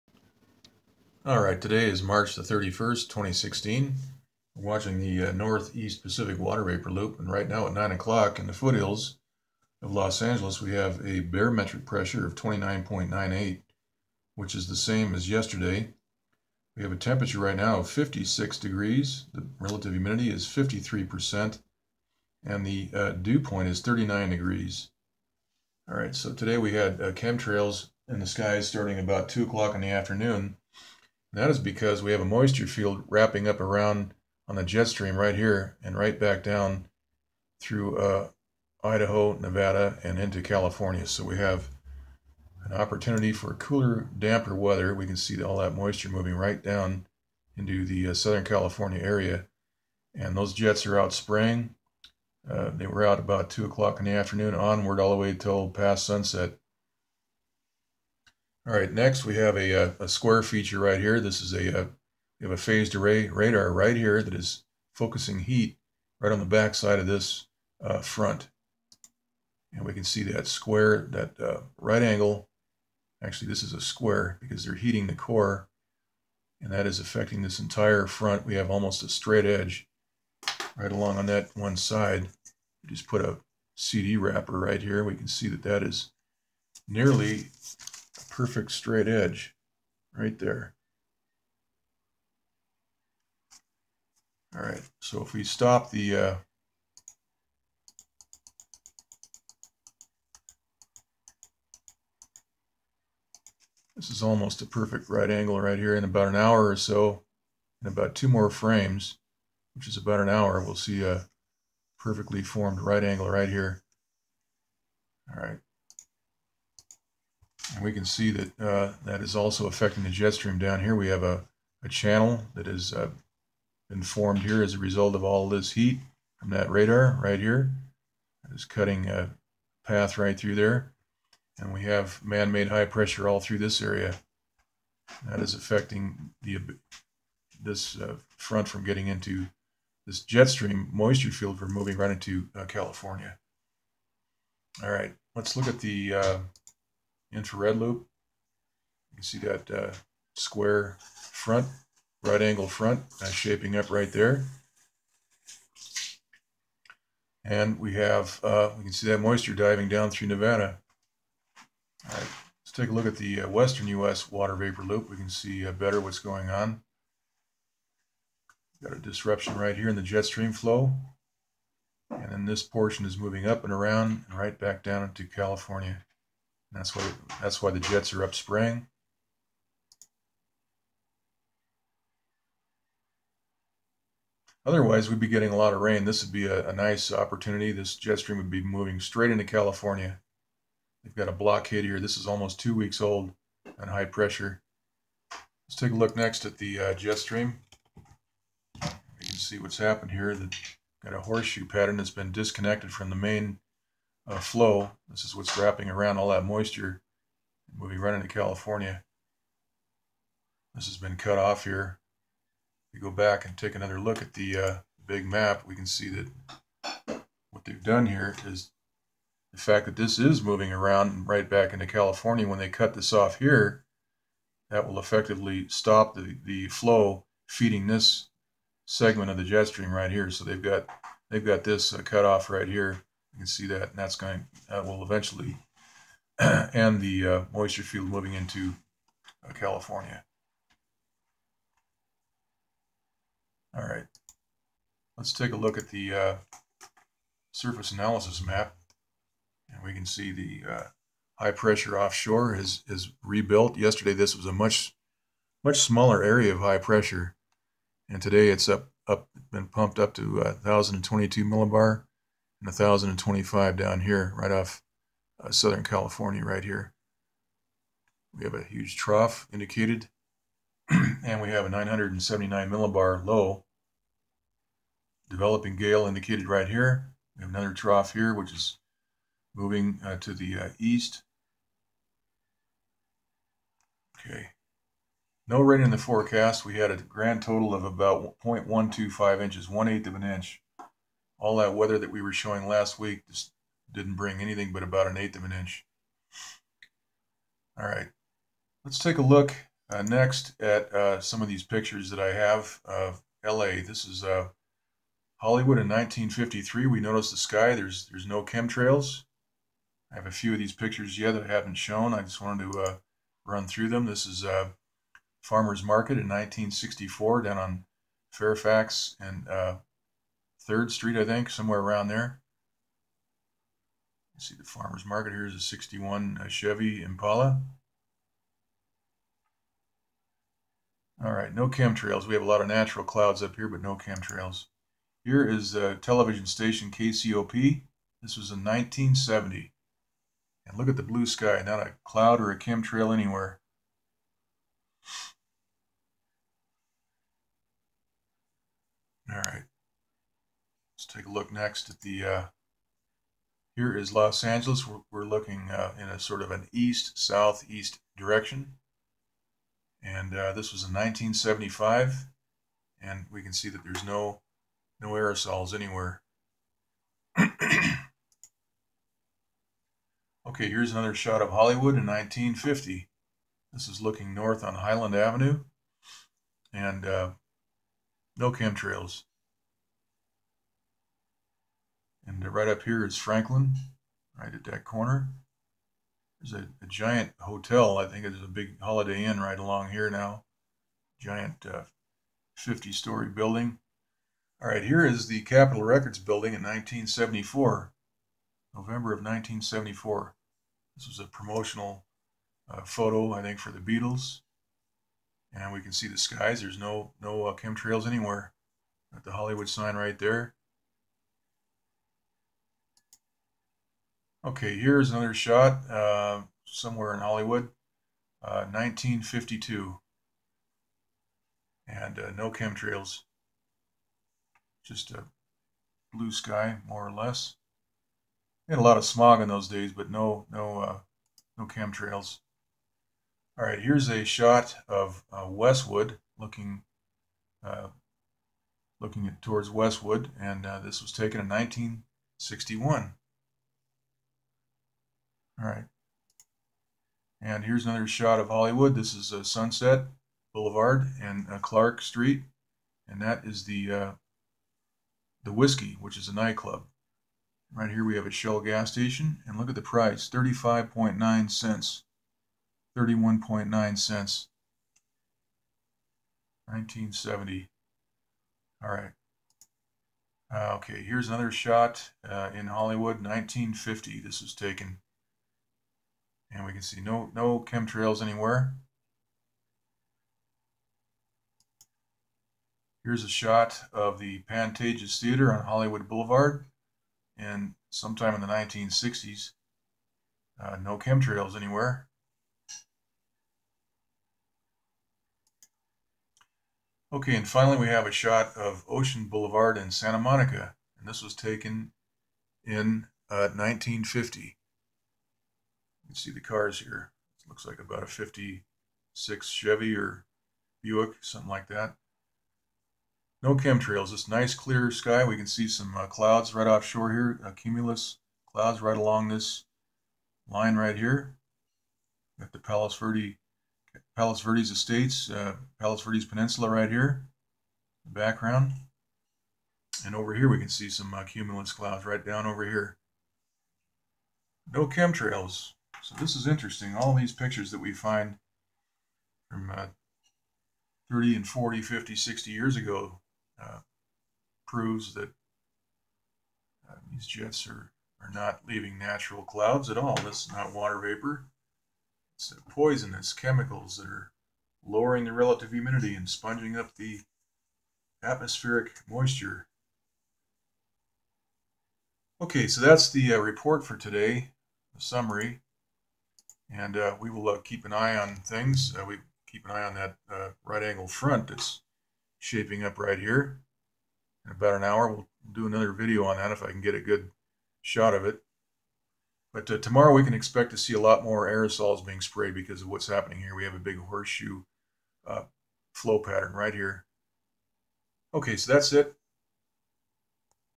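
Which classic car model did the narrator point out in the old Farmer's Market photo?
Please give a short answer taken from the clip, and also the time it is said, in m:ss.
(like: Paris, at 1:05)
Chevy Impala, at 5:26.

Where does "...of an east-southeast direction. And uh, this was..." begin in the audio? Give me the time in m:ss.
5:56.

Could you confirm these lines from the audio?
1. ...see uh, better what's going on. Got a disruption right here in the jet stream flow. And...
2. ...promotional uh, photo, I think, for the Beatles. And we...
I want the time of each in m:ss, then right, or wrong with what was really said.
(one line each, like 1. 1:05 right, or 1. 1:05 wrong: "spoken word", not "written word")
1. 2:45 right
2. 6:41 right.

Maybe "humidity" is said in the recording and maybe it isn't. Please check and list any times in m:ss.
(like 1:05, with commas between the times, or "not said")
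0:19, 9:15.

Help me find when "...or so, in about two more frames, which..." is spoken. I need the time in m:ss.
1:46.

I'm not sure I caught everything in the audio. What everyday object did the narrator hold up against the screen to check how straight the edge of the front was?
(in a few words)
CD wrapper.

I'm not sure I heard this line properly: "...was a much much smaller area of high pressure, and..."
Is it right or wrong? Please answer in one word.
right.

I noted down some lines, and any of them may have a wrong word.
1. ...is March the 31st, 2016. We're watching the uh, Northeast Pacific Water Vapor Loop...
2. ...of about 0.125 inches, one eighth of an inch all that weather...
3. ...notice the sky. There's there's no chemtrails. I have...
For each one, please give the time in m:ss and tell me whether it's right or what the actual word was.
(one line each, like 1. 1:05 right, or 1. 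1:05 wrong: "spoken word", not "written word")
1. 0:01 right
2. 4:47 right
3. 5:06 right.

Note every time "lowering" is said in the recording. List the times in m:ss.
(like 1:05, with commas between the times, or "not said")
9:14.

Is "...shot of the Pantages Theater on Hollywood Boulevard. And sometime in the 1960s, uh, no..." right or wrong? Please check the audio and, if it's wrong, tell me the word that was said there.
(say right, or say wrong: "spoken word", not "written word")
right.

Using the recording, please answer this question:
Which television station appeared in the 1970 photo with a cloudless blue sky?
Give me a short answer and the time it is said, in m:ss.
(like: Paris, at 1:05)
KCOP, at 5:36.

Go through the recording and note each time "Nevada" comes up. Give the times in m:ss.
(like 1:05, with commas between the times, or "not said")
0:39, 2:40.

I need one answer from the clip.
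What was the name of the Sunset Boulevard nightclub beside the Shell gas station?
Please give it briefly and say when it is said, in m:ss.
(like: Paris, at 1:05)
the Whisky, at 7:35.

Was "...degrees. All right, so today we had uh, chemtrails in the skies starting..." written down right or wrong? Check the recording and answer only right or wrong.
right.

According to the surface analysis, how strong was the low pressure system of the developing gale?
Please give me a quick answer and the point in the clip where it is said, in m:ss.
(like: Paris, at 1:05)
979 millibar, at 4:31.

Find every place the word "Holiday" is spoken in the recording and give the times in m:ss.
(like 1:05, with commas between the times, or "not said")
6:28.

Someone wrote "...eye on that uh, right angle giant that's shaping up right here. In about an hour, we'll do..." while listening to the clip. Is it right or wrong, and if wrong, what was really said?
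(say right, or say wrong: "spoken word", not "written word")
wrong: "front", not "giant".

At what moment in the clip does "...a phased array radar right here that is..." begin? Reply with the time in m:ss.
1:02.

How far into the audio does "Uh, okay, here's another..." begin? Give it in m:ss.
7:50.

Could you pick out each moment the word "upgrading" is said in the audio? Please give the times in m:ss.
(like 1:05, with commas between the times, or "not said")
not said.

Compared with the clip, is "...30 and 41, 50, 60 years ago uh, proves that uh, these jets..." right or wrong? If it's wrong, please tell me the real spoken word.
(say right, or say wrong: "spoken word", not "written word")
wrong: "40", not "41".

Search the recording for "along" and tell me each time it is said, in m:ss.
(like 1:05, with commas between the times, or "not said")
1:20, 6:29, 8:38.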